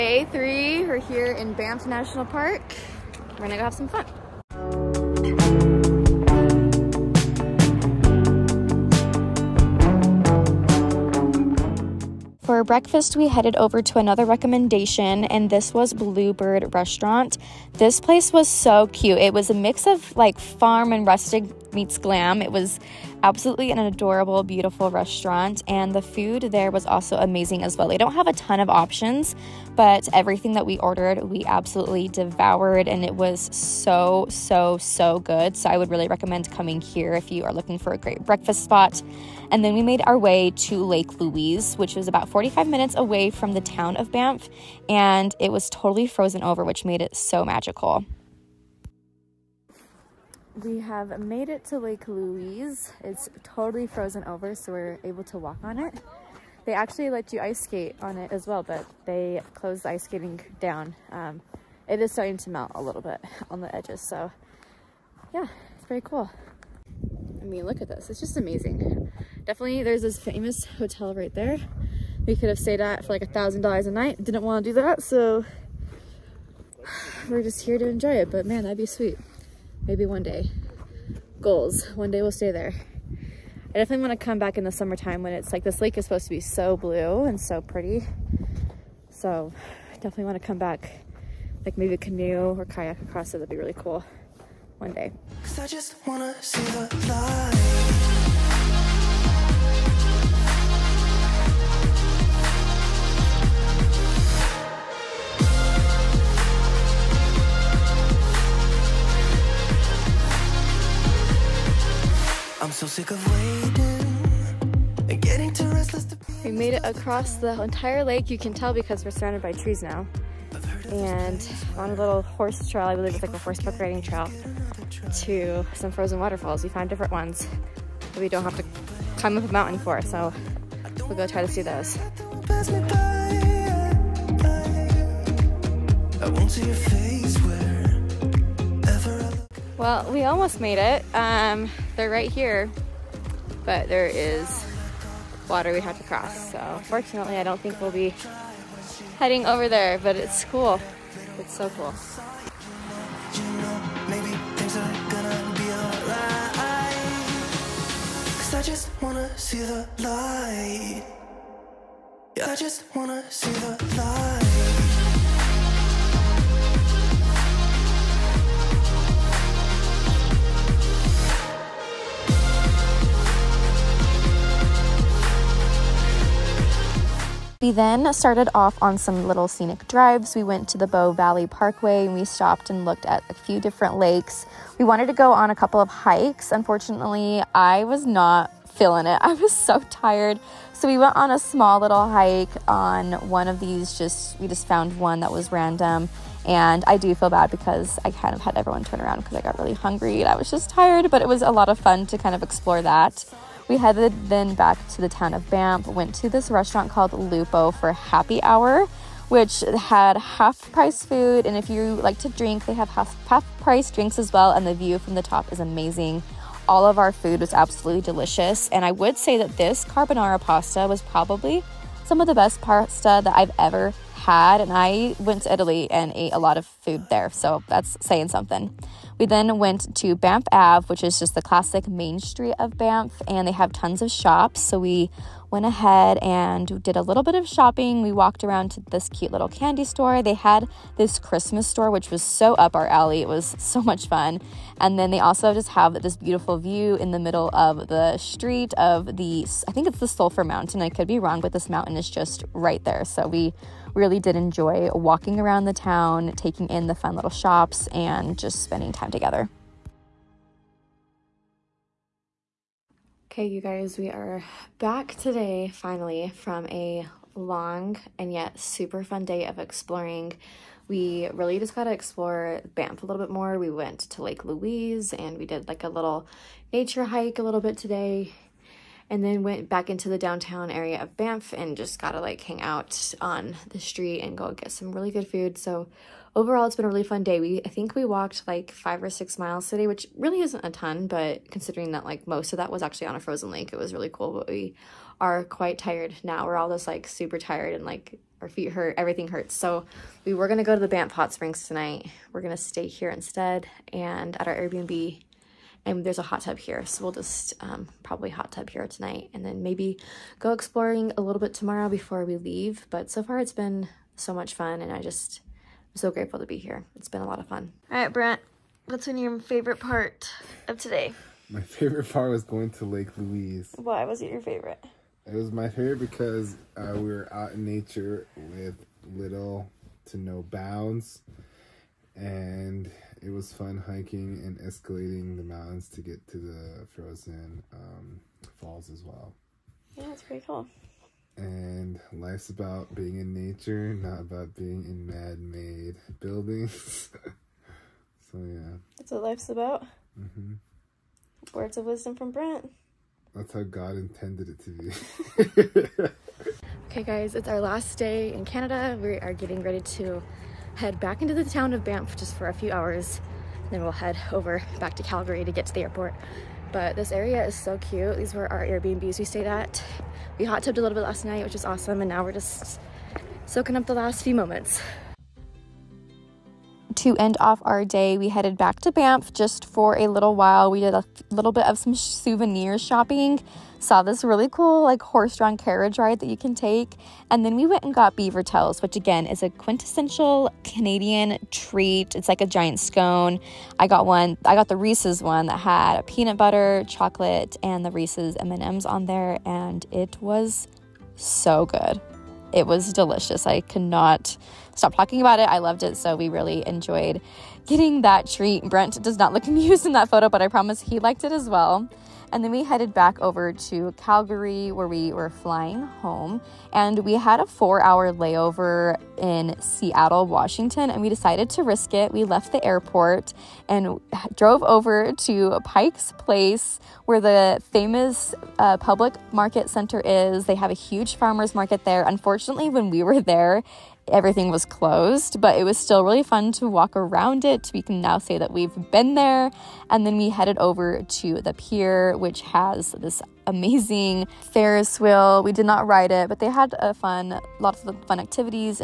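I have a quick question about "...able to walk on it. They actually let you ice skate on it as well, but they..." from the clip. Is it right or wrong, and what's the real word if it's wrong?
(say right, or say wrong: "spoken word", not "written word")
right.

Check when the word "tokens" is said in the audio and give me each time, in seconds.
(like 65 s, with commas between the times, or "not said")
not said.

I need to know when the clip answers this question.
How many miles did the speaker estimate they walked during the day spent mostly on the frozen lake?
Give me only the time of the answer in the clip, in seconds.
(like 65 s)
288 s.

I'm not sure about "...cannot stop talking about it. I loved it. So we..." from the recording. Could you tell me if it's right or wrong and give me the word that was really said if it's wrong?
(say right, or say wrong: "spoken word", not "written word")
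right.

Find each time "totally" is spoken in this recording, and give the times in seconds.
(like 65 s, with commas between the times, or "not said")
45 s, 53 s.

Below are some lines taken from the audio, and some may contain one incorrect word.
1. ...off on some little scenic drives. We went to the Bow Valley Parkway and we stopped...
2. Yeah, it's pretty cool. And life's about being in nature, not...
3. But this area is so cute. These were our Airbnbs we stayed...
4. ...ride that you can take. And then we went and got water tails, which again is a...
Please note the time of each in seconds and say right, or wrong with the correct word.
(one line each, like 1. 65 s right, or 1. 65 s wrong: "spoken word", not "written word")
1. 178 s right
2. 339 s right
3. 366 s right
4. 385 s wrong: "beaver", not "water".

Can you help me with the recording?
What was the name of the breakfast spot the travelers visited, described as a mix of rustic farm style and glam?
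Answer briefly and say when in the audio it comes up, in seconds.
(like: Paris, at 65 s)
Bluebird Restaurant, at 15 s.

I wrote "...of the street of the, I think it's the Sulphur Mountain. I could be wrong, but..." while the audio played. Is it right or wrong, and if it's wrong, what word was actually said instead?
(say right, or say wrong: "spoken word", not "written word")
right.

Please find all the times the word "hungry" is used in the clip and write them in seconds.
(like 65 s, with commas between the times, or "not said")
199 s.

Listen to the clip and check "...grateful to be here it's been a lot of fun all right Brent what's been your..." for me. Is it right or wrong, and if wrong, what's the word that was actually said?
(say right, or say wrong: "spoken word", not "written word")
right.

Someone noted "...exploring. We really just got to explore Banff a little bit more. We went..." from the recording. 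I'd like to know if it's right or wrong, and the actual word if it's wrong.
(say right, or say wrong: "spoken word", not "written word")
right.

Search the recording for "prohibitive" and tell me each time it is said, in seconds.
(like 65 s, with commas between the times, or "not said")
not said.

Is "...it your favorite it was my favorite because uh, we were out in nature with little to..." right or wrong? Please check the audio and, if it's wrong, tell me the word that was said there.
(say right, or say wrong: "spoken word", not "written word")
right.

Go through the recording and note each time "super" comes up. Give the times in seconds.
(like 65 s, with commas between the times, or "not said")
268 s, 297 s.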